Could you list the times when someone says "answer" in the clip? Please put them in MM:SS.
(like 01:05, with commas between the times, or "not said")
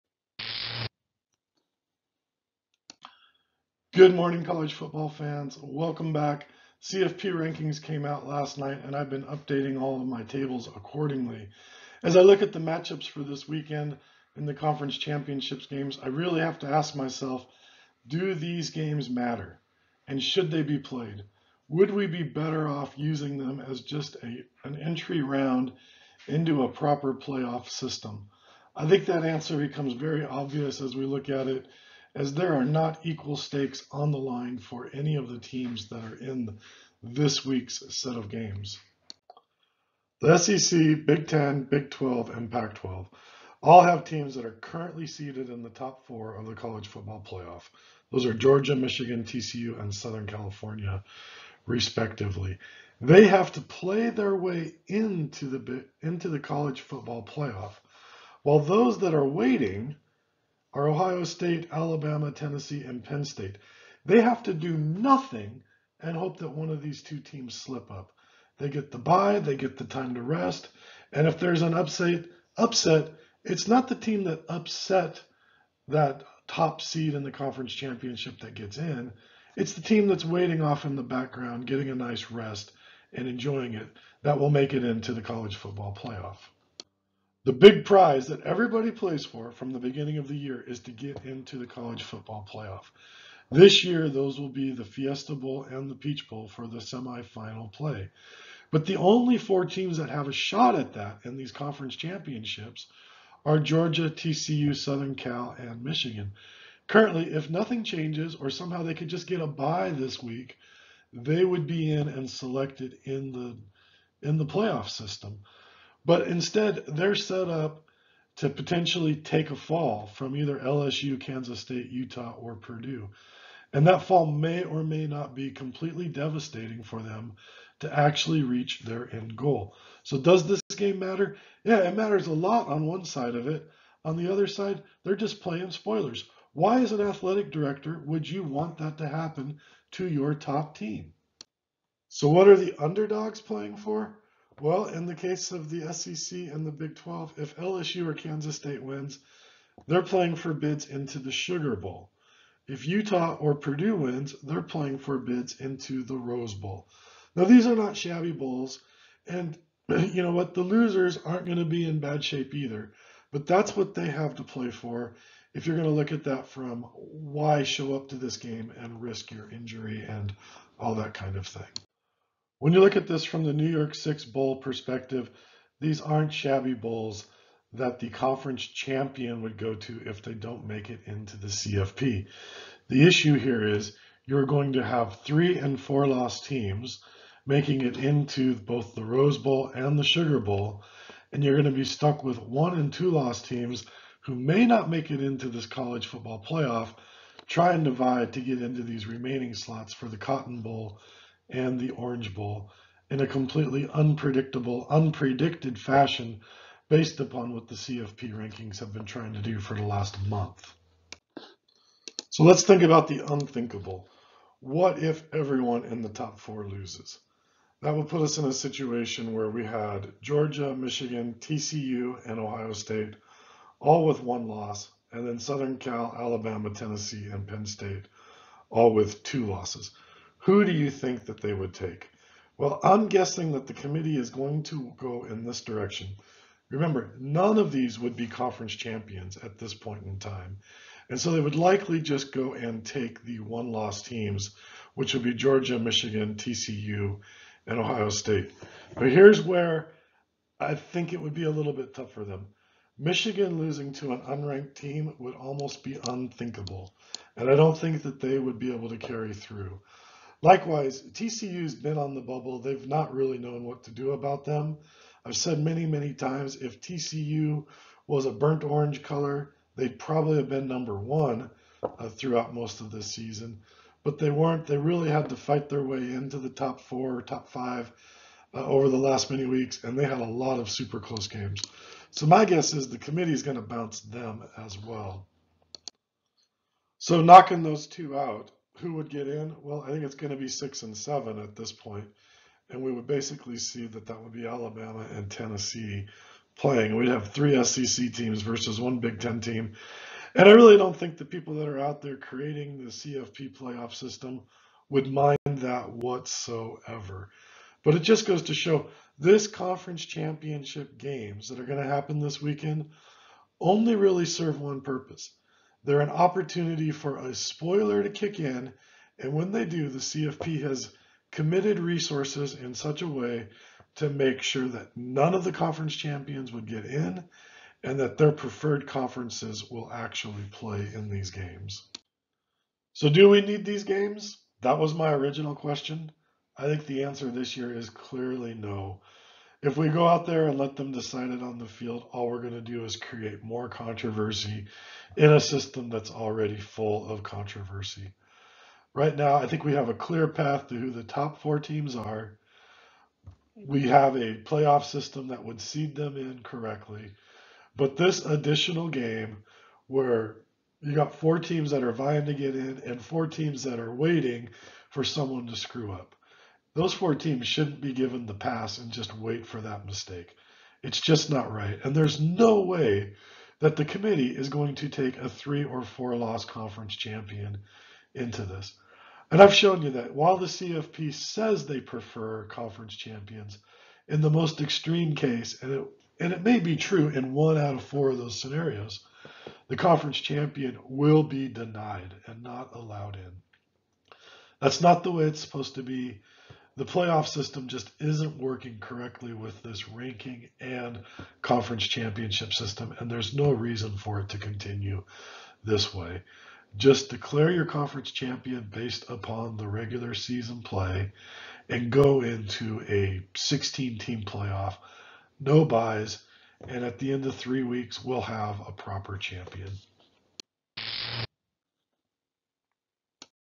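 00:29, 05:37.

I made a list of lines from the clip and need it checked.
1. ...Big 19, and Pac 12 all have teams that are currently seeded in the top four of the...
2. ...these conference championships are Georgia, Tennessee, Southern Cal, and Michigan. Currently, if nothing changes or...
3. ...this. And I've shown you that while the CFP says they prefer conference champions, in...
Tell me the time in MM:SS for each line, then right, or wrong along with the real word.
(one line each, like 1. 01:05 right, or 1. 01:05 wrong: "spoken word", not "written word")
1. 00:41 wrong: "12", not "19"
2. 01:41 wrong: "TCU", not "Tennessee"
3. 06:18 right.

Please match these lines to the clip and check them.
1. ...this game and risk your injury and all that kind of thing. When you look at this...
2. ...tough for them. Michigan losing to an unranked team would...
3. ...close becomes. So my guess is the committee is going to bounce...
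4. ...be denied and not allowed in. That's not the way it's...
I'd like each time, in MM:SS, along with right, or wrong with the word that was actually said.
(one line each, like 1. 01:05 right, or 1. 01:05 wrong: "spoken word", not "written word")
1. 02:48 right
2. 04:11 right
3. 04:40 wrong: "games", not "becomes"
4. 06:31 right.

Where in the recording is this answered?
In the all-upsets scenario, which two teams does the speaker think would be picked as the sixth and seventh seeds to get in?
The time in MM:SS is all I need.
04:54.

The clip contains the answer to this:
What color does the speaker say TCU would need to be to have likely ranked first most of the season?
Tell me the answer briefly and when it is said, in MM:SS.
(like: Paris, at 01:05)
burnt orange, at 04:28.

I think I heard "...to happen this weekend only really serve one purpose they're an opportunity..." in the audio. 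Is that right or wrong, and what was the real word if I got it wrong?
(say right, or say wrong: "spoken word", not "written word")
right.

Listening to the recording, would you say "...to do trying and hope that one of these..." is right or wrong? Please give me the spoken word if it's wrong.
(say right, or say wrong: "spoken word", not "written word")
wrong: "nothing", not "trying".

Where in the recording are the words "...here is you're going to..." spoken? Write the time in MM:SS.
03:03.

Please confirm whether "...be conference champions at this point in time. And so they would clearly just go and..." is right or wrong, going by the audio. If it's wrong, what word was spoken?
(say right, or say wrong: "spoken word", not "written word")
wrong: "likely", not "clearly".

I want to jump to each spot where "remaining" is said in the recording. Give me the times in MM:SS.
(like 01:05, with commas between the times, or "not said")
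03:19.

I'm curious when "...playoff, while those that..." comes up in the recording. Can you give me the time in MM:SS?
00:57.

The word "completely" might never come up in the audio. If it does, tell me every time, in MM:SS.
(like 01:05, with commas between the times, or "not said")
02:05, 03:23.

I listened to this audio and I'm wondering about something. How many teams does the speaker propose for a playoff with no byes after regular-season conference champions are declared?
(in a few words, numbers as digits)
16.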